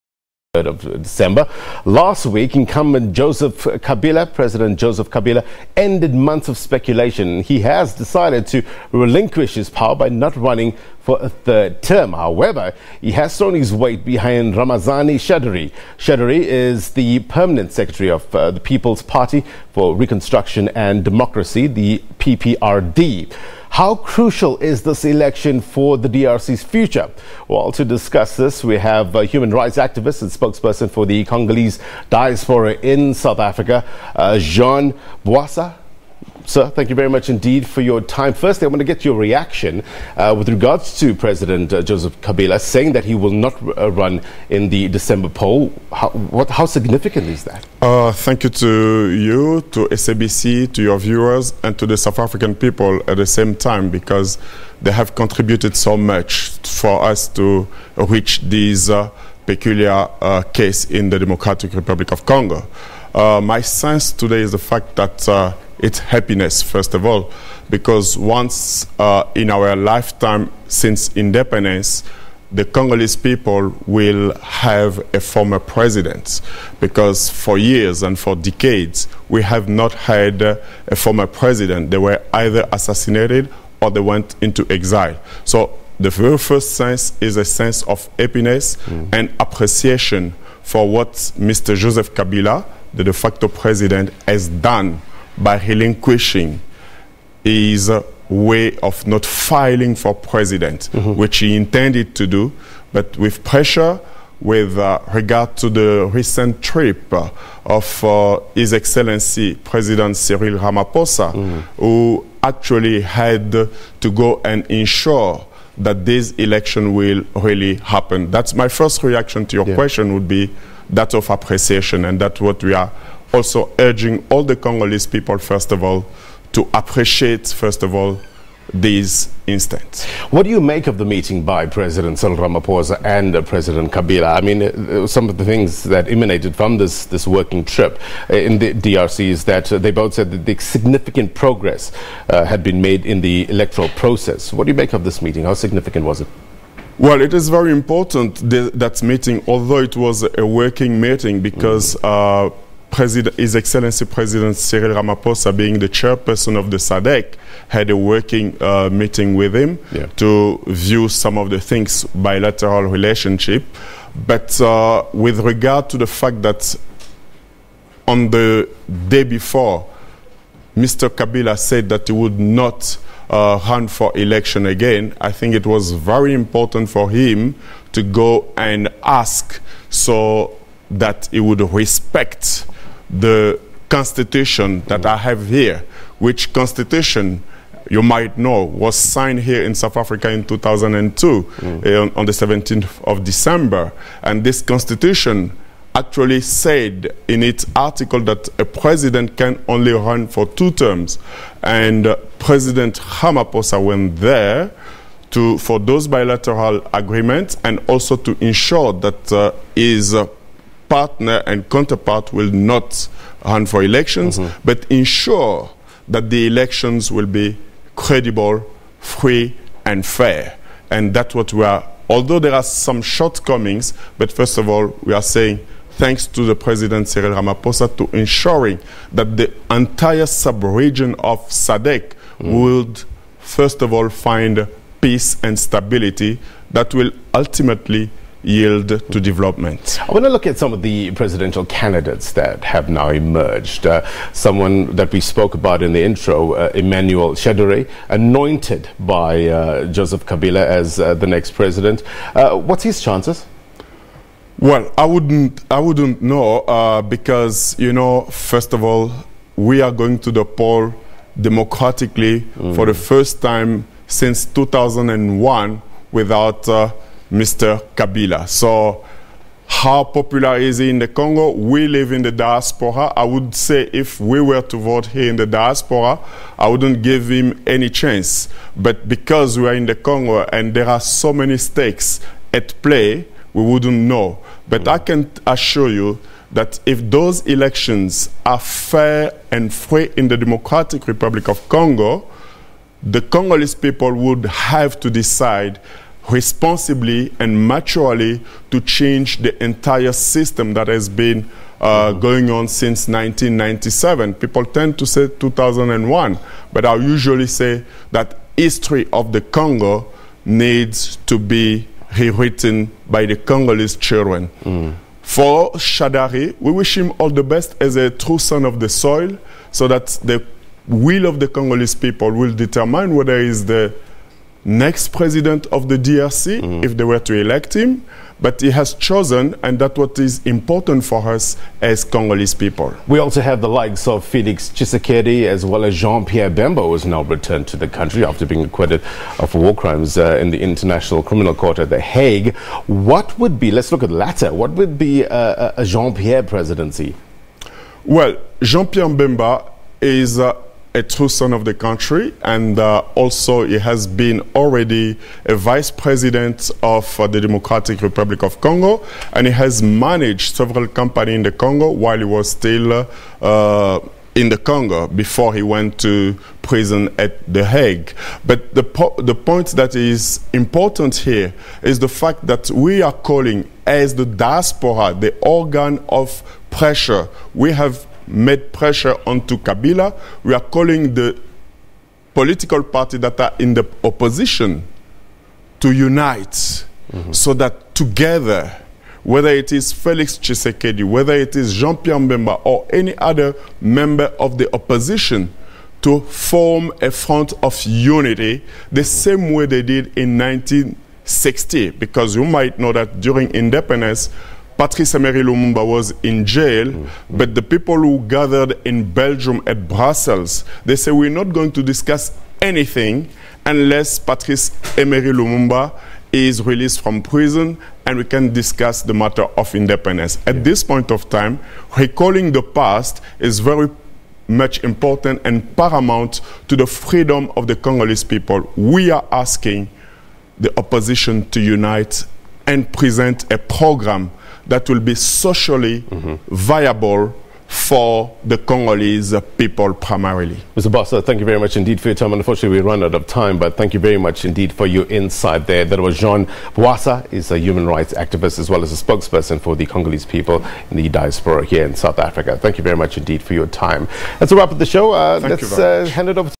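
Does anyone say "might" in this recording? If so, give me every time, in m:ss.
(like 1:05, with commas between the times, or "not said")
3:08, 6:42.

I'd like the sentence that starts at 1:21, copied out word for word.
They were either assassinated or they went into exile.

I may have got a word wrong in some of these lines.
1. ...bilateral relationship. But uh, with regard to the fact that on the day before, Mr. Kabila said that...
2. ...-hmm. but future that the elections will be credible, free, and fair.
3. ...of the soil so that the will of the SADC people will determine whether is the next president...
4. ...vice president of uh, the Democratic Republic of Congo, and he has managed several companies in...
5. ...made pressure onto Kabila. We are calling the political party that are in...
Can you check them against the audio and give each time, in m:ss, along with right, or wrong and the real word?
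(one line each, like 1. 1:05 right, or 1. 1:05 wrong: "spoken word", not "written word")
1. 2:42 right
2. 3:34 wrong: "ensure", not "future"
3. 5:18 wrong: "Congolese", not "SADC"
4. 5:55 right
5. 6:18 right.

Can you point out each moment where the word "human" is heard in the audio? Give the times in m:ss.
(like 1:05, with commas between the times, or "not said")
0:29, 7:27.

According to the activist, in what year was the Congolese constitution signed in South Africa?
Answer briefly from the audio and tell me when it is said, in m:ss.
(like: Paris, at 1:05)
2002, at 3:10.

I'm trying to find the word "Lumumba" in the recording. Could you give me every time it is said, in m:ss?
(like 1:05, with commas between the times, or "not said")
6:45, 6:55.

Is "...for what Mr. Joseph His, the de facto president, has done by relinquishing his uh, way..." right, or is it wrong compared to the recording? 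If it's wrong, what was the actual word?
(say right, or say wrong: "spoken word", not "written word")
wrong: "Kabila", not "His".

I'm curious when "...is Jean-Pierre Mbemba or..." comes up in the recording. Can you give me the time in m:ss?
6:31.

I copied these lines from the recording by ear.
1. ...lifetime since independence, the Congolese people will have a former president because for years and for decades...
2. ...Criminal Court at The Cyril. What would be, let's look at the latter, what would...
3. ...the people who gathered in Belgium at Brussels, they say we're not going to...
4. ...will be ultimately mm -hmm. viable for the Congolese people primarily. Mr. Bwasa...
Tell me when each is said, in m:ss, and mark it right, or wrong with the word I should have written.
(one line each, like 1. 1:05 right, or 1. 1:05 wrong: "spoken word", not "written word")
1. 1:09 right
2. 5:41 wrong: "Hague", not "Cyril"
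3. 6:47 right
4. 7:14 wrong: "socially", not "ultimately".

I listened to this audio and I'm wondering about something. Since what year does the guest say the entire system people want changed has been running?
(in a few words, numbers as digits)
1997.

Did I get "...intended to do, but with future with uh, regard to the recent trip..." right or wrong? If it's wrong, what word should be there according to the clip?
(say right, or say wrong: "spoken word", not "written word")
wrong: "pressure", not "future".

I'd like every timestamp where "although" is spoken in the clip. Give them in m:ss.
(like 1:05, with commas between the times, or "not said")
2:29, 3:42.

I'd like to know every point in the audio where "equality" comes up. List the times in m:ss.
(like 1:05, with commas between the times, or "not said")
not said.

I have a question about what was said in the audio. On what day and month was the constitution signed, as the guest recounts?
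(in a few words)
17 December.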